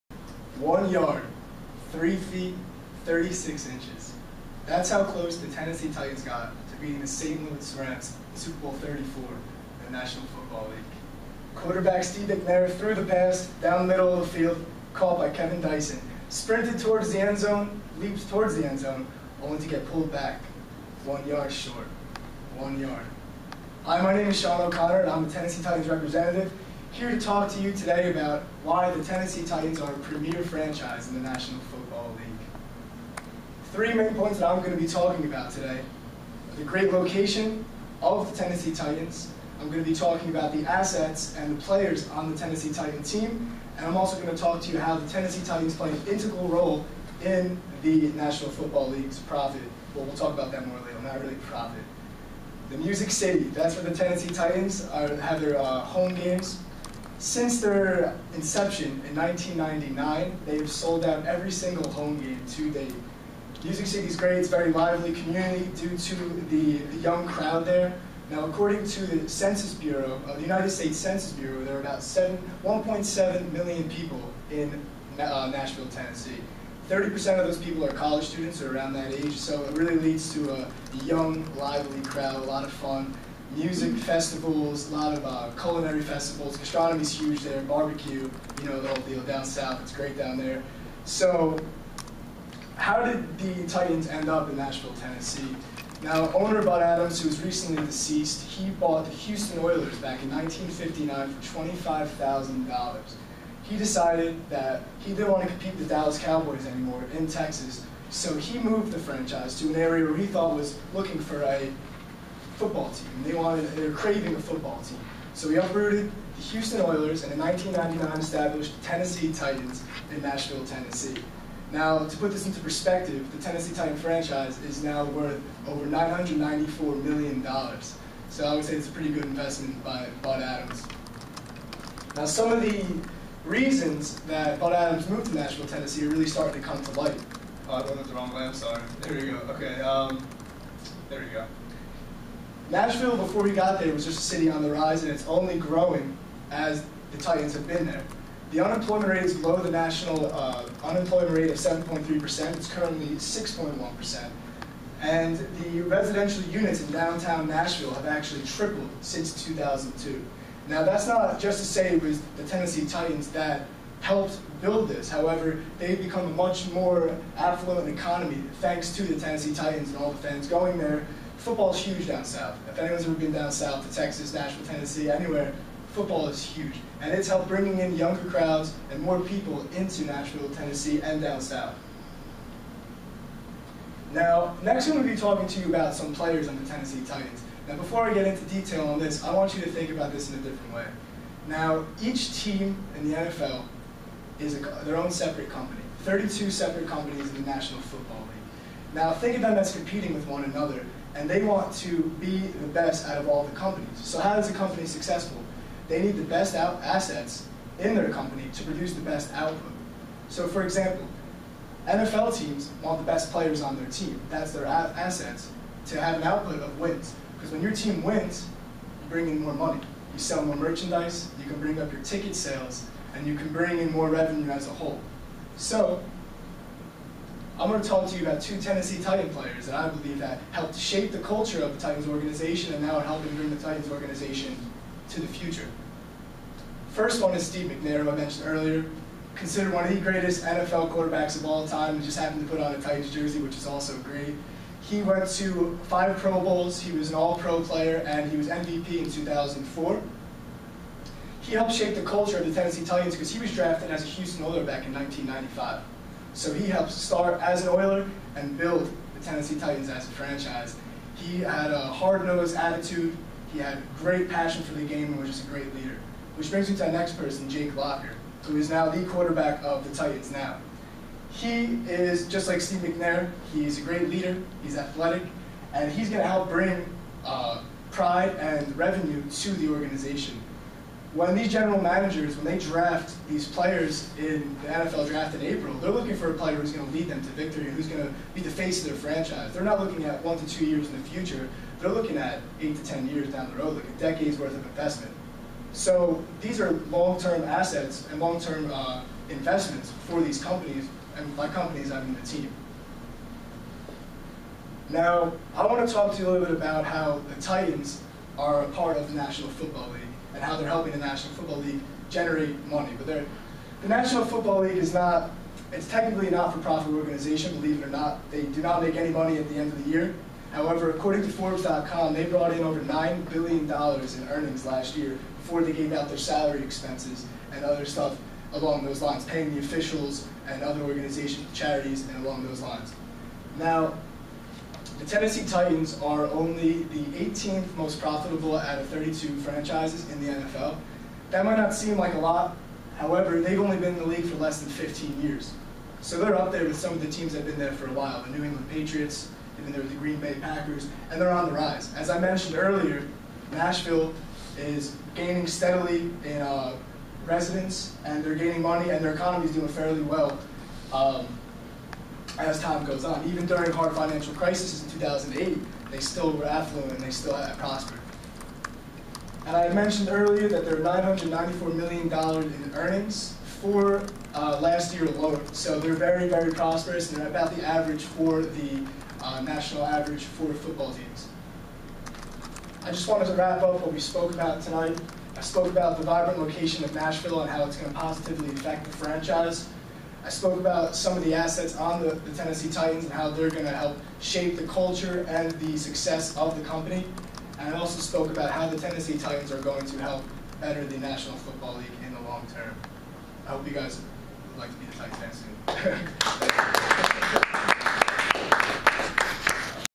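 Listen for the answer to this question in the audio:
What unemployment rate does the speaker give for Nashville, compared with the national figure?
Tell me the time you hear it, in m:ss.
2:33.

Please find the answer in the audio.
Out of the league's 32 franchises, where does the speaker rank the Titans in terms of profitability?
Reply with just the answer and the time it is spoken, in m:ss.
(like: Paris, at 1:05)
18th, at 5:37.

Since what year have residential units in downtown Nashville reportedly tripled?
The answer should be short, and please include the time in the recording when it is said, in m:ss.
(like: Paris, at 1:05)
2002, at 2:39.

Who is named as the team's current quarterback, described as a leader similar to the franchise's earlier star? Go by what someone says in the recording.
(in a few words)
Jake Locker.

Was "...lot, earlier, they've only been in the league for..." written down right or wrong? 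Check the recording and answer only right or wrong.
wrong.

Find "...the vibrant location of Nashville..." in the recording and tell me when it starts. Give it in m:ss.
6:25.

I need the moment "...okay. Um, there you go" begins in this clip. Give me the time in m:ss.
2:19.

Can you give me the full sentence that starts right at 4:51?
They're looking at eight to ten years down the road, like a decade's worth of investment.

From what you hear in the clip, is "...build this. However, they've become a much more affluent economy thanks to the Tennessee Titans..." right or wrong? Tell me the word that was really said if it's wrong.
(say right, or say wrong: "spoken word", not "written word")
right.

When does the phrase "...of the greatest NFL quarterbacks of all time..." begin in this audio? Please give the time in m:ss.
3:59.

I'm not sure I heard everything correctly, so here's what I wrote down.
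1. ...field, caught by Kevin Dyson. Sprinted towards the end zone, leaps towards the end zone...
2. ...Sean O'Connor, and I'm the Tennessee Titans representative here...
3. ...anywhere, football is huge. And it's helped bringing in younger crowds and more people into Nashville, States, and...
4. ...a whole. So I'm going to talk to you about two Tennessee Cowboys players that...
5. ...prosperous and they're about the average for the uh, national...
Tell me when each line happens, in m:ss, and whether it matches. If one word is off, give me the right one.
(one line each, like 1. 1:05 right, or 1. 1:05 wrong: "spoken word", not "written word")
1. 0:14 right
2. 0:24 right
3. 2:55 wrong: "Tennessee", not "States"
4. 3:44 wrong: "Titan", not "Cowboys"
5. 6:16 right.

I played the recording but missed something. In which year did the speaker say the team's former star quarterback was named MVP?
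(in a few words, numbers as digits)
2004.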